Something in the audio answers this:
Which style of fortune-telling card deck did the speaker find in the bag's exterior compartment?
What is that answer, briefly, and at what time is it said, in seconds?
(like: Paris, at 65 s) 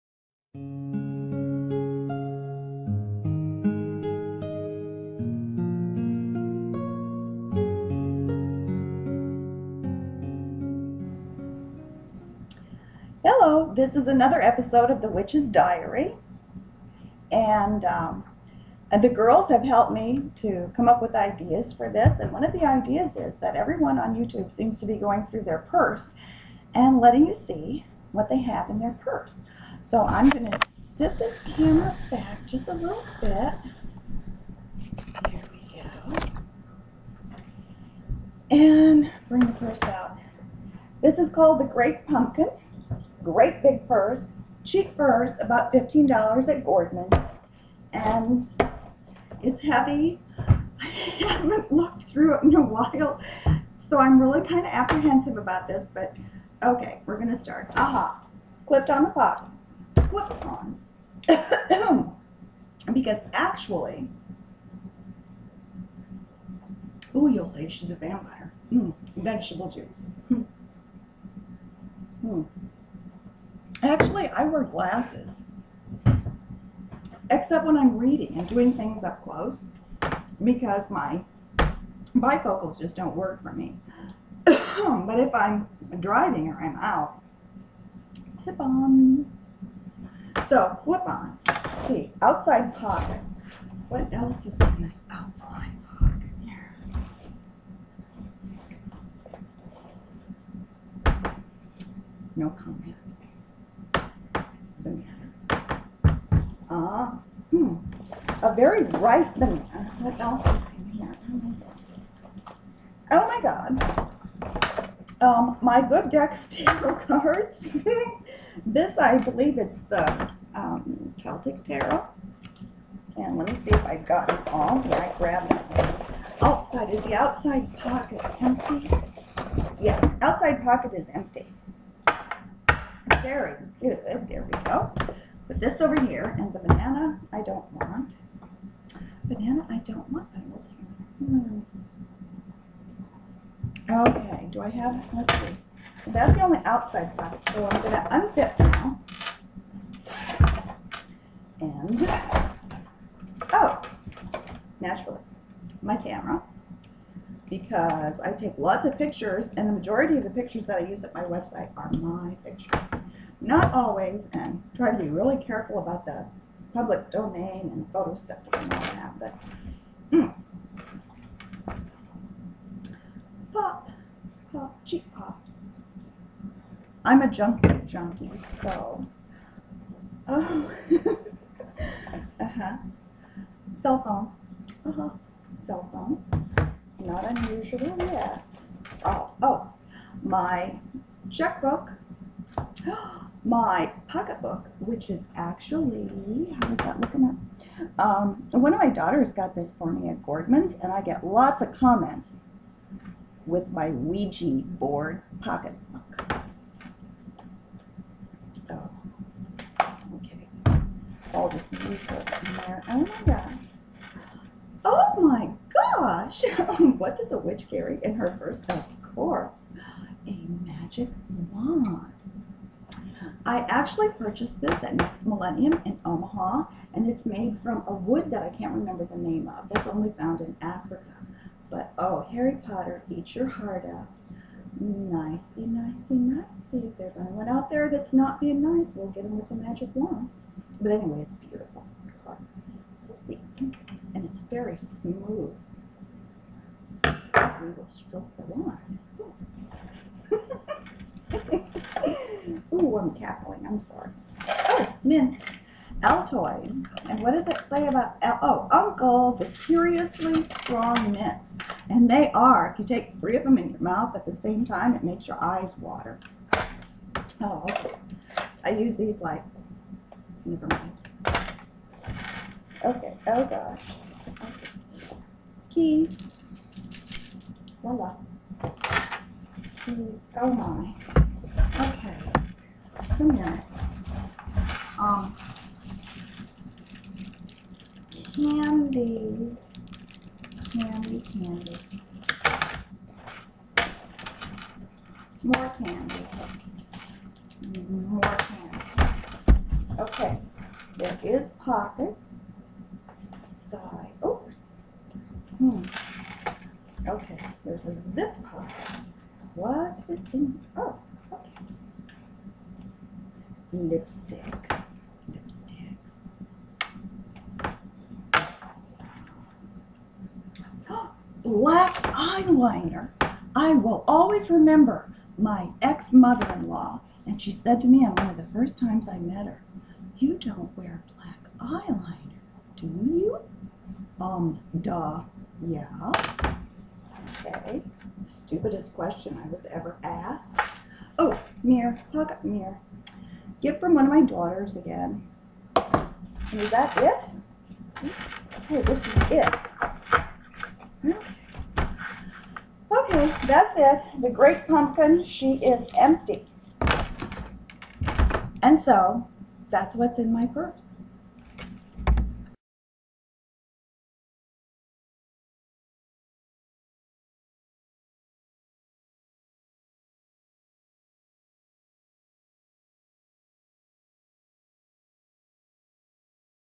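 Celtic Tarot, at 121 s.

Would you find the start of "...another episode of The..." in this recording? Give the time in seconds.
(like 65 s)
14 s.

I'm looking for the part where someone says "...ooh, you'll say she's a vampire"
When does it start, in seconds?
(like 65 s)
67 s.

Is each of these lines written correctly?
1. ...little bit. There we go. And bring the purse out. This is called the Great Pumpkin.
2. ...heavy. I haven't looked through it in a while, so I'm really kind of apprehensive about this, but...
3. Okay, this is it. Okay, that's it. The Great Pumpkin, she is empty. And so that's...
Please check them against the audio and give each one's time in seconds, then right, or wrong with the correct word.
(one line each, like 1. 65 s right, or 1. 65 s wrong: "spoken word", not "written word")
1. 32 s right
2. 49 s right
3. 348 s right.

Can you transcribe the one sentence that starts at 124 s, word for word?
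Yeah, I grabbed it, Outside, is the outside pocket empty?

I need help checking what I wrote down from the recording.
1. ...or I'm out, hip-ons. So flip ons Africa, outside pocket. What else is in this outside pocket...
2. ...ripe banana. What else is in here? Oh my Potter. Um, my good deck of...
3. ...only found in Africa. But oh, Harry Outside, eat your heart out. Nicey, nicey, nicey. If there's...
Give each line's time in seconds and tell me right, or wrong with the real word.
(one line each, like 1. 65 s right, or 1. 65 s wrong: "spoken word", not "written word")
1. 86 s wrong: "See", not "Africa"
2. 108 s wrong: "God", not "Potter"
3. 229 s wrong: "Potter", not "Outside".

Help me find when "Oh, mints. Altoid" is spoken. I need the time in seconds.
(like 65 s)
254 s.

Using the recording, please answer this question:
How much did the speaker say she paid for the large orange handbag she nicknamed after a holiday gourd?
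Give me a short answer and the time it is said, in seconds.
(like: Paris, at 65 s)
$15, at 45 s.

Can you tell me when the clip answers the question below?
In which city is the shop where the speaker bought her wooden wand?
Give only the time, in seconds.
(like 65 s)
226 s.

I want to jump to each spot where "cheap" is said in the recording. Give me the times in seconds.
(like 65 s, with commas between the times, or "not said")
44 s, 174 s.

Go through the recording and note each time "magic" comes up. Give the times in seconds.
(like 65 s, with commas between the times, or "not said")
220 s, 239 s.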